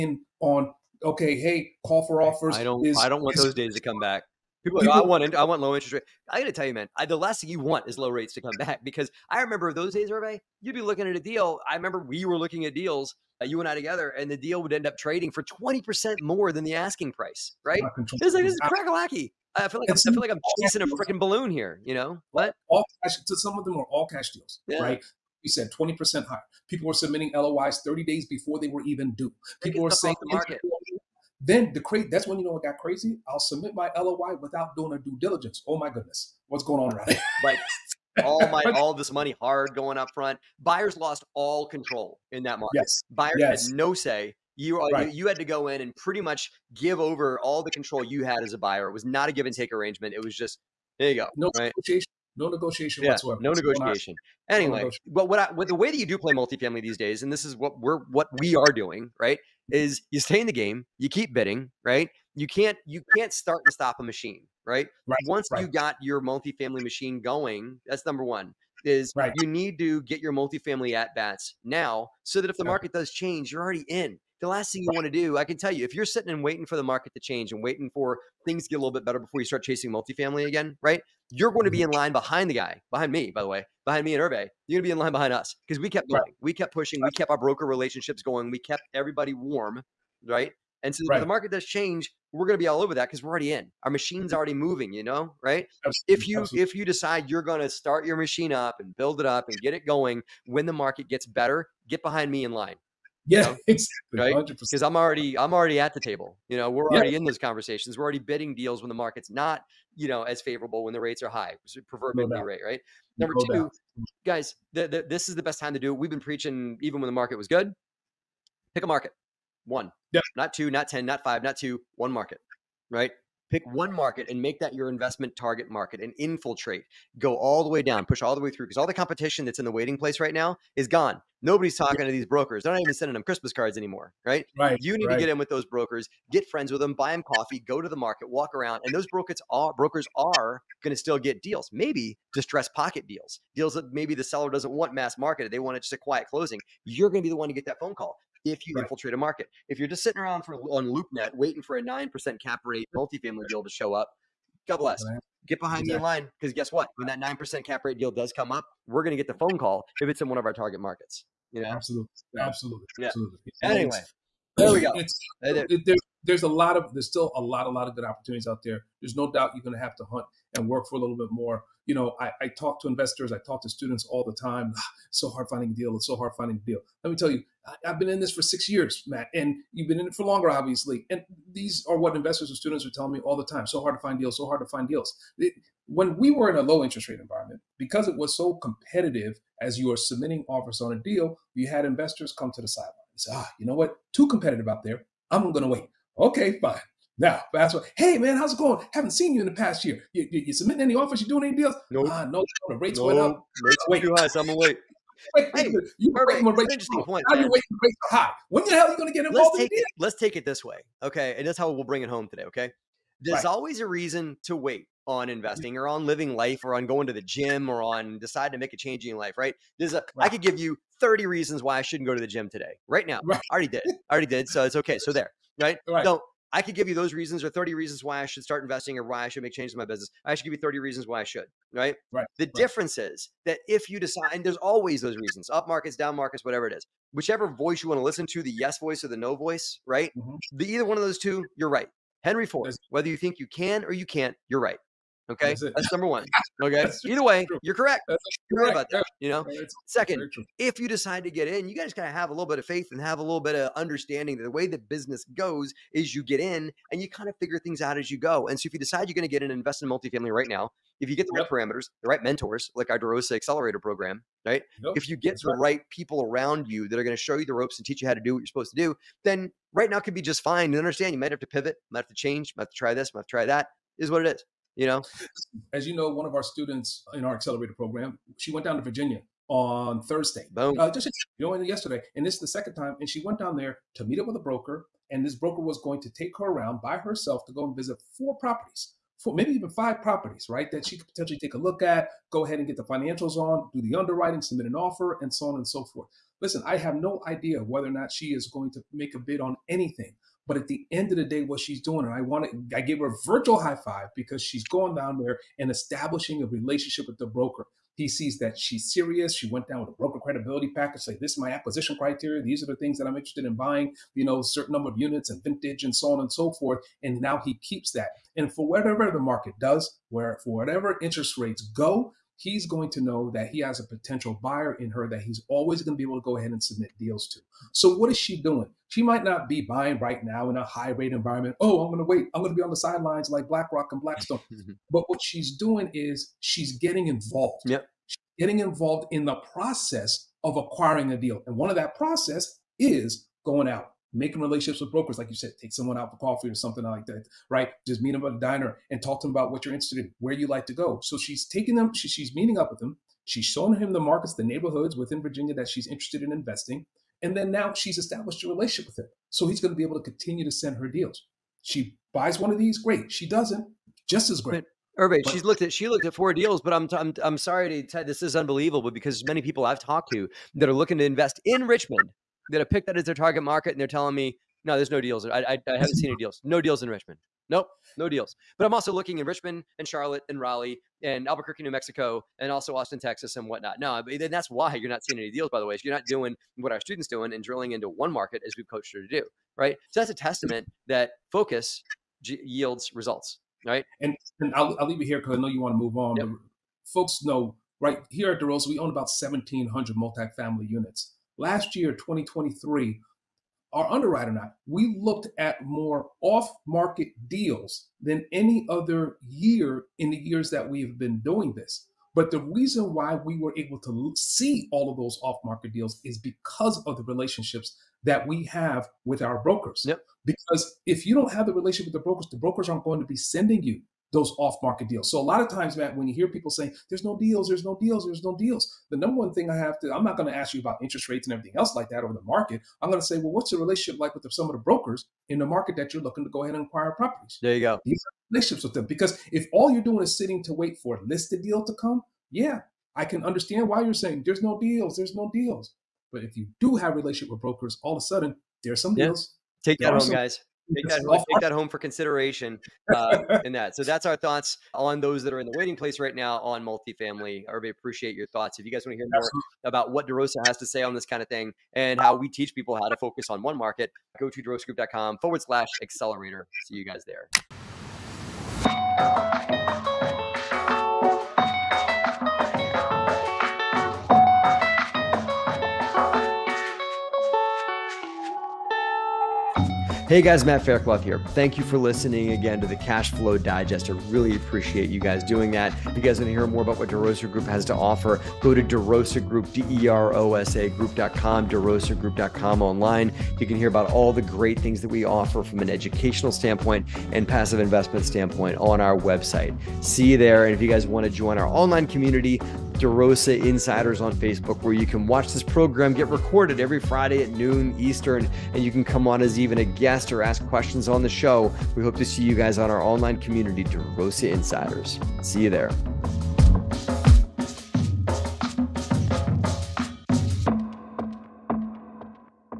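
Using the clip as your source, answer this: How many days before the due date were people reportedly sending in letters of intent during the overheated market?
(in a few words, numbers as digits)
30.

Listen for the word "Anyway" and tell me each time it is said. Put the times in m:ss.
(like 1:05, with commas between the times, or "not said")
0:54, 2:43.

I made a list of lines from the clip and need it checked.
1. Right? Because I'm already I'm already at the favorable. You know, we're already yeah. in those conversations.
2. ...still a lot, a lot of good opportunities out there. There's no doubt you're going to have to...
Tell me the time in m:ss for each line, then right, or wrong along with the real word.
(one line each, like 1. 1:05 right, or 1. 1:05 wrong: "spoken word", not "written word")
1. 1:44 wrong: "table", not "favorable"
2. 2:47 right.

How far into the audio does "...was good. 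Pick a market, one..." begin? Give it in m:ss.
1:57.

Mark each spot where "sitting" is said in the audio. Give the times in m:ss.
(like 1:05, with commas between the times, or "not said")
1:16, 2:30, 7:20.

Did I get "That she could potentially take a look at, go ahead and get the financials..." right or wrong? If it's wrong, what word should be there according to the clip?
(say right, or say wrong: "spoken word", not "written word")
right.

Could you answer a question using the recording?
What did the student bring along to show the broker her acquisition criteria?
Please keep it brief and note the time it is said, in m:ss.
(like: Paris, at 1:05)
broker credibility package, at 5:09.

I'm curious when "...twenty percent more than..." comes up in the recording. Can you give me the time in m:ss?
0:15.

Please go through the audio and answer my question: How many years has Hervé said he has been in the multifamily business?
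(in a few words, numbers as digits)
6.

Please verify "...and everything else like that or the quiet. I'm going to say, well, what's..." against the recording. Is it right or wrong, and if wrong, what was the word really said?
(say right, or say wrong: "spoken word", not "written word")
wrong: "market", not "quiet".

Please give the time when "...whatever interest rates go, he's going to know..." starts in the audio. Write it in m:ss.
5:20.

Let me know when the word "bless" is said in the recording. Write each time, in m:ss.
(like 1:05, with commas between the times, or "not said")
2:34.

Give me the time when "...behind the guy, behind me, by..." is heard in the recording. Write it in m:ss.
1:22.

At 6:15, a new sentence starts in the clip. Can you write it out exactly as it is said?
I, I, I haven't seen any deals.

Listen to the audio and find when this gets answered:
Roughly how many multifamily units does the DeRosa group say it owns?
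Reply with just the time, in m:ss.
6:39.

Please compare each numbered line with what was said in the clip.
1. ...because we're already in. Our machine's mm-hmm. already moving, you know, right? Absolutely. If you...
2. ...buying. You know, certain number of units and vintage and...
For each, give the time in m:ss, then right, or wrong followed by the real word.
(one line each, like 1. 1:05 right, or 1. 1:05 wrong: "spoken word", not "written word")
1. 1:33 right
2. 5:13 right.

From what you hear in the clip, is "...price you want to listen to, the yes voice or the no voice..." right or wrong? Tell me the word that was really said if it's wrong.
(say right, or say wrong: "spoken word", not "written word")
wrong: "voice", not "price".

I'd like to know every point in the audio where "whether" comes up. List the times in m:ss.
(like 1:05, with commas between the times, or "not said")
4:02, 4:57.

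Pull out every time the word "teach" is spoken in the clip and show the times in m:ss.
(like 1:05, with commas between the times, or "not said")
4:27, 7:42.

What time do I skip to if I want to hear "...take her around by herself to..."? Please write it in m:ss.
4:46.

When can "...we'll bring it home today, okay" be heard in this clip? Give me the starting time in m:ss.
3:31.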